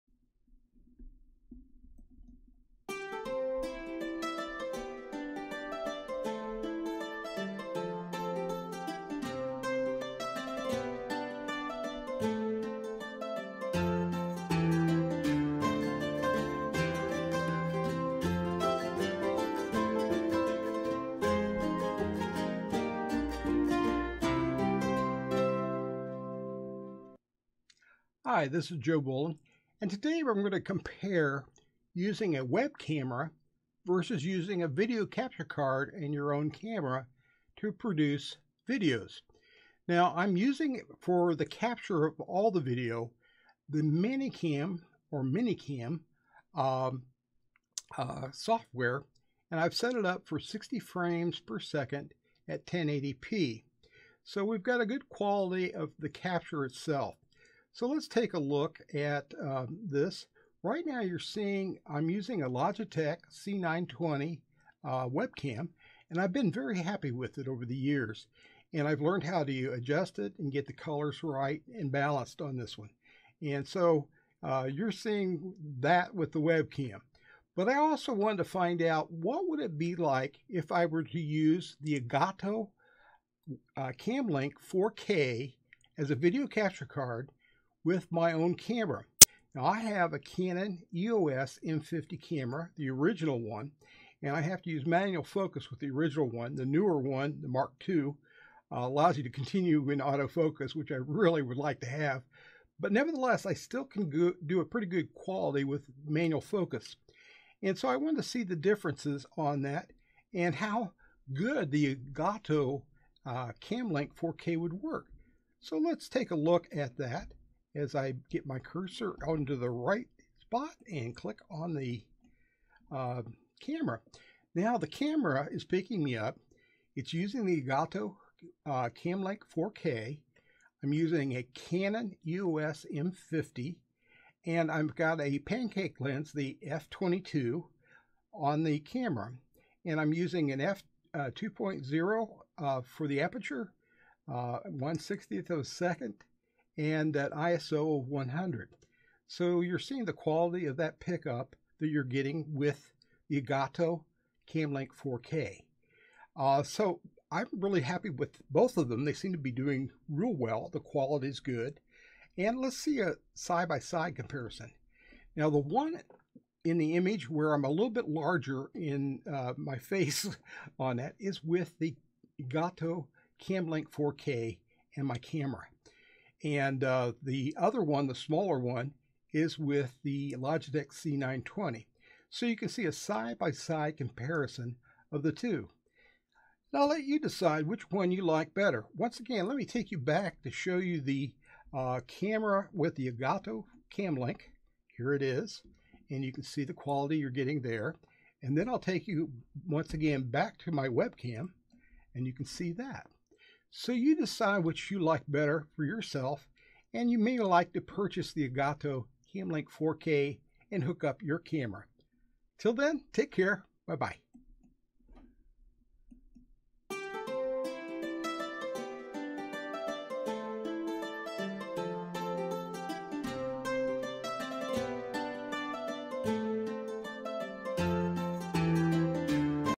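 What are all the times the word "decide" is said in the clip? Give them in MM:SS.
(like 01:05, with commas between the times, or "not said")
03:07, 03:24.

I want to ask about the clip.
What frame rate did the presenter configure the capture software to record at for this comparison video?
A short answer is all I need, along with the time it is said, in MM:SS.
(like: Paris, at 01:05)
60 frames per second, at 00:50.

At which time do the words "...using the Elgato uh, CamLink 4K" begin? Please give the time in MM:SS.
02:07.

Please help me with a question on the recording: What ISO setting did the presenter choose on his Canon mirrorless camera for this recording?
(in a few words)
100.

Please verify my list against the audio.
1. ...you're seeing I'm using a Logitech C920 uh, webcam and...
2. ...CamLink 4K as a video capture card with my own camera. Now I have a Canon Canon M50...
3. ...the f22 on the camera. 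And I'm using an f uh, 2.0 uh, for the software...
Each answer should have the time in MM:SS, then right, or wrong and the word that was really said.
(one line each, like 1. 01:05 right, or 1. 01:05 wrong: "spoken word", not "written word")
1. 01:01 right
2. 01:23 wrong: "EOS", not "Canon"
3. 02:16 wrong: "aperture", not "software".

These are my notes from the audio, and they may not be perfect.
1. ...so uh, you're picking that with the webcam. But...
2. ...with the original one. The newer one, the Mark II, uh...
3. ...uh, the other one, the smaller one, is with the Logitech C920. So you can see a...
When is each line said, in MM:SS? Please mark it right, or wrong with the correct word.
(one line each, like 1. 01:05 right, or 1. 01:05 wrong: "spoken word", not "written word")
1. 01:13 wrong: "seeing", not "picking"
2. 01:35 right
3. 02:56 right.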